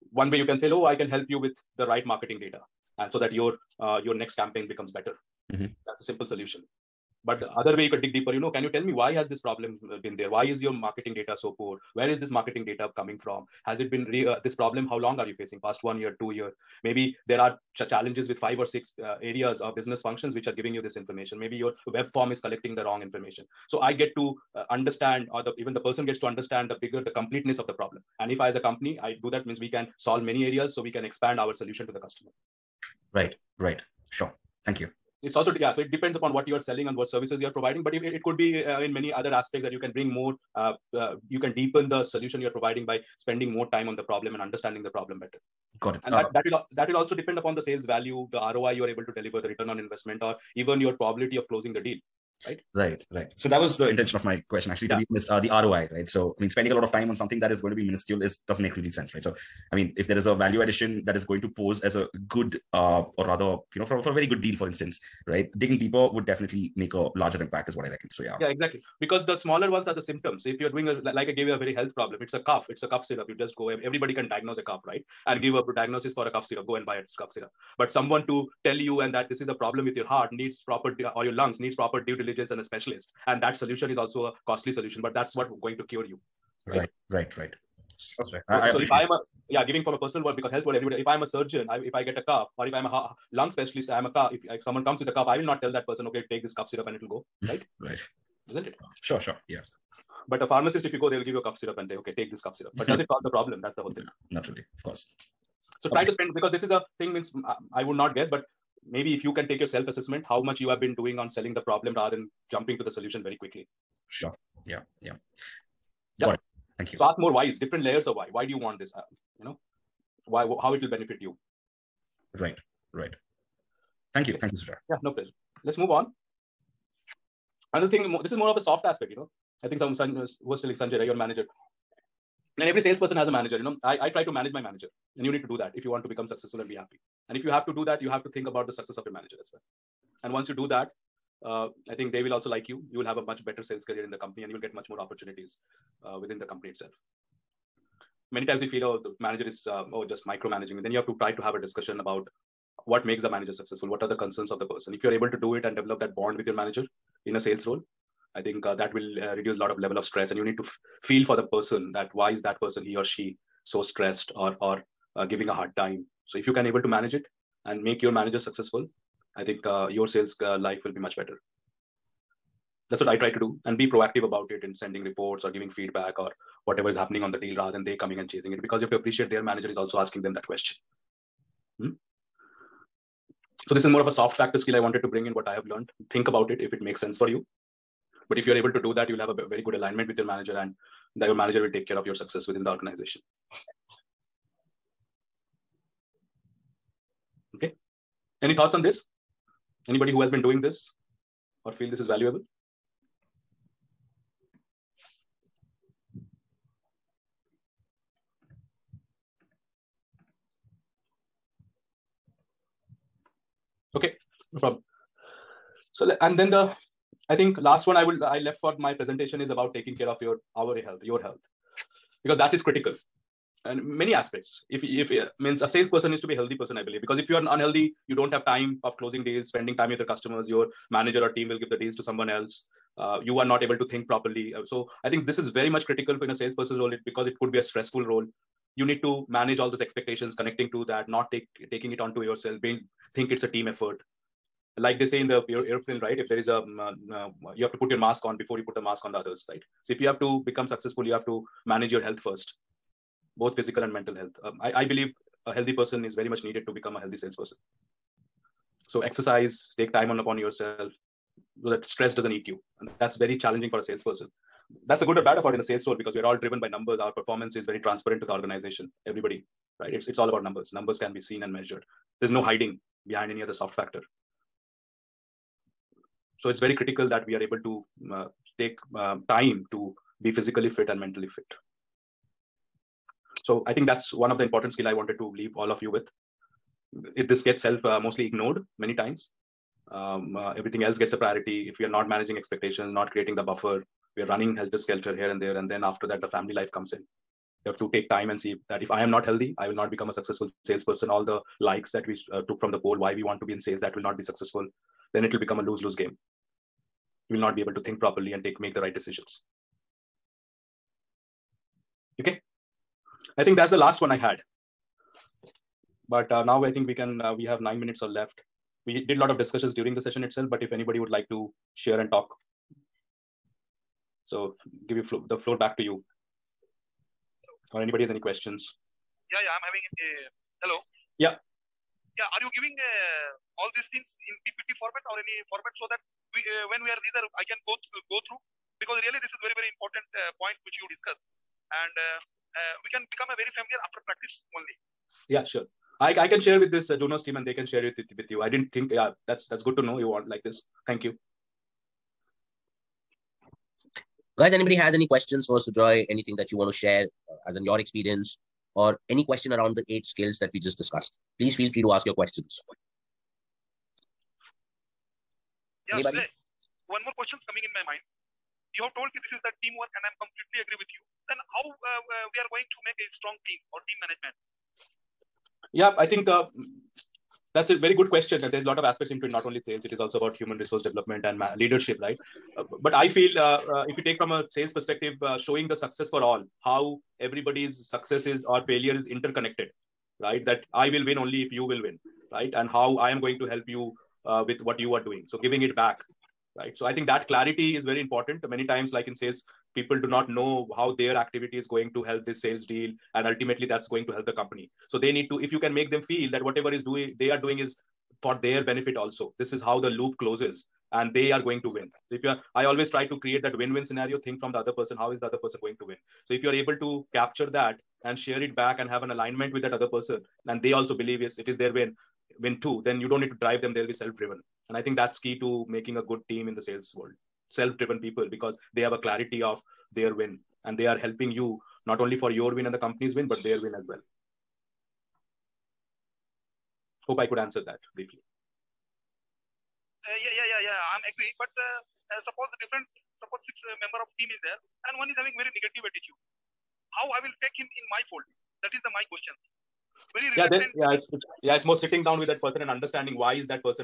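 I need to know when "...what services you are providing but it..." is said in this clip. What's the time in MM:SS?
00:36.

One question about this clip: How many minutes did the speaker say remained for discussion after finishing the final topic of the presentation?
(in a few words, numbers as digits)
9.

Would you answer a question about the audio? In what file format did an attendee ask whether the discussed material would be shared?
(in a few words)
PPT.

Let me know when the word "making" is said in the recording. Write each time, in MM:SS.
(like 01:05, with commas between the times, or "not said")
07:05.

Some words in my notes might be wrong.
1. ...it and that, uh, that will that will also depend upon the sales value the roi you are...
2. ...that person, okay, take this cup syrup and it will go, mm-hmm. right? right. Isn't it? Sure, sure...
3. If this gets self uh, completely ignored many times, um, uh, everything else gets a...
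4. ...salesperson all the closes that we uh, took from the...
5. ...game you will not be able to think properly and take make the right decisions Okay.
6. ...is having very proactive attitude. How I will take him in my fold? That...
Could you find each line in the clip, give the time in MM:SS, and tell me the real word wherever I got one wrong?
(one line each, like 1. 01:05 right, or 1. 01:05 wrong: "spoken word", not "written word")
1. 00:45 right
2. 01:35 right
3. 04:47 wrong: "mostly", not "completely"
4. 05:00 wrong: "likes", not "closes"
5. 05:05 right
6. 07:25 wrong: "negative", not "proactive".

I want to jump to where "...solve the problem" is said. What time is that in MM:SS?
01:43.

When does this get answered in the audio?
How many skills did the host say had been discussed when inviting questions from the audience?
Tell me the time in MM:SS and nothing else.
05:59.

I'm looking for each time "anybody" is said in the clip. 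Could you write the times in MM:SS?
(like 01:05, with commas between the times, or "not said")
03:19, 05:20, 05:27, 05:54, 06:05.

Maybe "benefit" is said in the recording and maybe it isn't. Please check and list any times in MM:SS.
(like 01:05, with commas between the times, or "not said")
02:00, 06:48.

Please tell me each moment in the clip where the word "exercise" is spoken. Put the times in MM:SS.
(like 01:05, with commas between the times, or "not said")
04:19.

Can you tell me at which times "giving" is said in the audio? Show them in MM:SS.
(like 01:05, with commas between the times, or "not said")
00:20, 01:29, 02:45, 02:55, 05:32, 06:35.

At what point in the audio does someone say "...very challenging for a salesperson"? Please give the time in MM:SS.
04:23.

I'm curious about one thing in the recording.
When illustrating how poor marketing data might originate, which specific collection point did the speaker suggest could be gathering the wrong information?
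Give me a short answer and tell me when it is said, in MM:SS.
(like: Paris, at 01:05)
web form, at 00:21.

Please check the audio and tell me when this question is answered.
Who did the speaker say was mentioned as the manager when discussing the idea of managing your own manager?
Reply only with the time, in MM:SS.
02:10.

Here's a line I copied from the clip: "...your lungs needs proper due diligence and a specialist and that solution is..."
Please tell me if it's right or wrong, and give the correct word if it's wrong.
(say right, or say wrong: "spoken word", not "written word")
right.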